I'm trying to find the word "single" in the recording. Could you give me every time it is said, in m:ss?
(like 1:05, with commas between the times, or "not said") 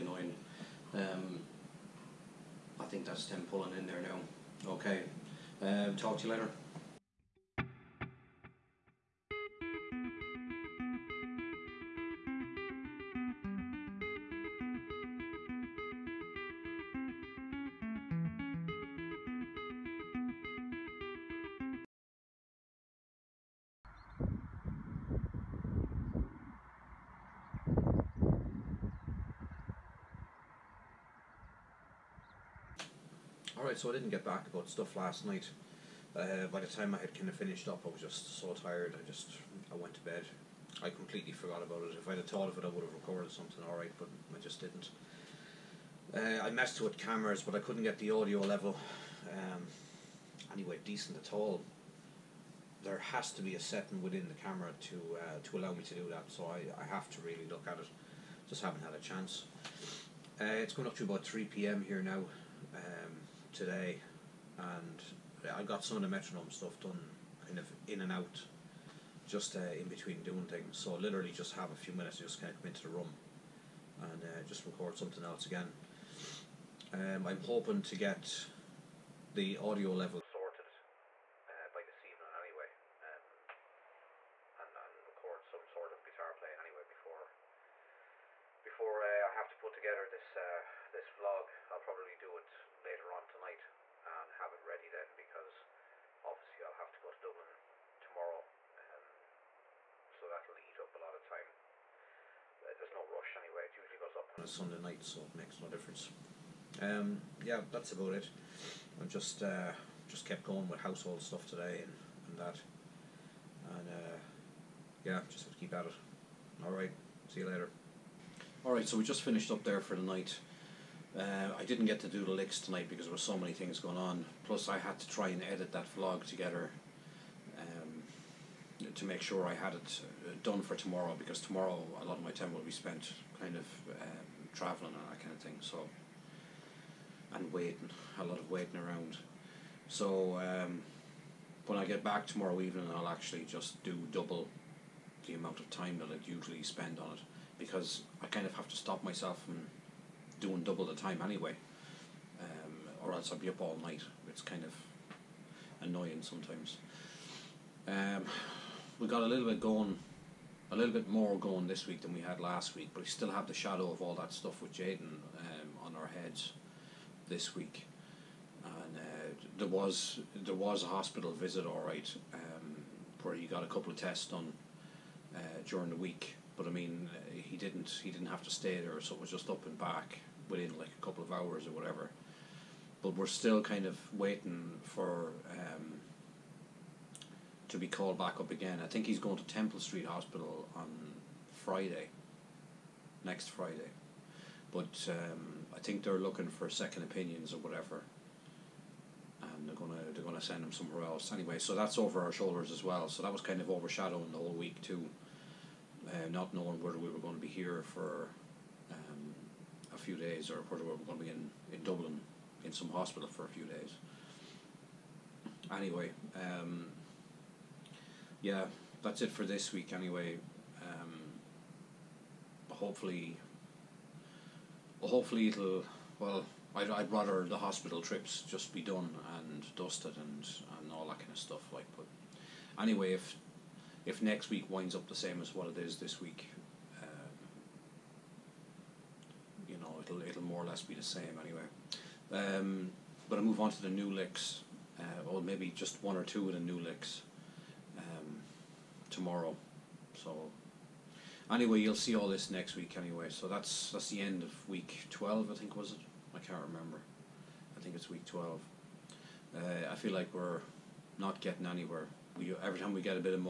not said.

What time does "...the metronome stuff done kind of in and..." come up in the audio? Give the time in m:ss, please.
1:06.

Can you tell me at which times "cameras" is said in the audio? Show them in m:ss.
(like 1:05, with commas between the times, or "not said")
0:46, 0:54.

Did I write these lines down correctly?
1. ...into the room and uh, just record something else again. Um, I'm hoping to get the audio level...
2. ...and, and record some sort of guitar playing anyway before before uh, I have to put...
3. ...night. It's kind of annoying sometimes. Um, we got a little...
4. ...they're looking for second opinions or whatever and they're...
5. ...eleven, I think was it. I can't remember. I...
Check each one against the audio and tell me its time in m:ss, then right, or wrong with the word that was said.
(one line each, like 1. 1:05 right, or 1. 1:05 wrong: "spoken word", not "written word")
1. 1:12 right
2. 1:24 right
3. 2:33 right
4. 3:16 right
5. 4:15 wrong: "twelve", not "eleven".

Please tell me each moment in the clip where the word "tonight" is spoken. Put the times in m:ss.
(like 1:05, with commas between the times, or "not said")
1:33, 2:02.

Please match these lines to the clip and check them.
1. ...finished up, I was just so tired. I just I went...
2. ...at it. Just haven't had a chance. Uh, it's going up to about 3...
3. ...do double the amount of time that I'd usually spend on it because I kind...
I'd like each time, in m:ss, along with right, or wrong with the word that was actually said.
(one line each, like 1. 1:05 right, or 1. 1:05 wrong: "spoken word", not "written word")
1. 0:37 right
2. 0:57 right
3. 2:23 right.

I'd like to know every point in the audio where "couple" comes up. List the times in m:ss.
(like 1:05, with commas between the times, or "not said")
2:53, 3:01.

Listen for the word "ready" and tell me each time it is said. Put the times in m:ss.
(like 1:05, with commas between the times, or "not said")
1:34.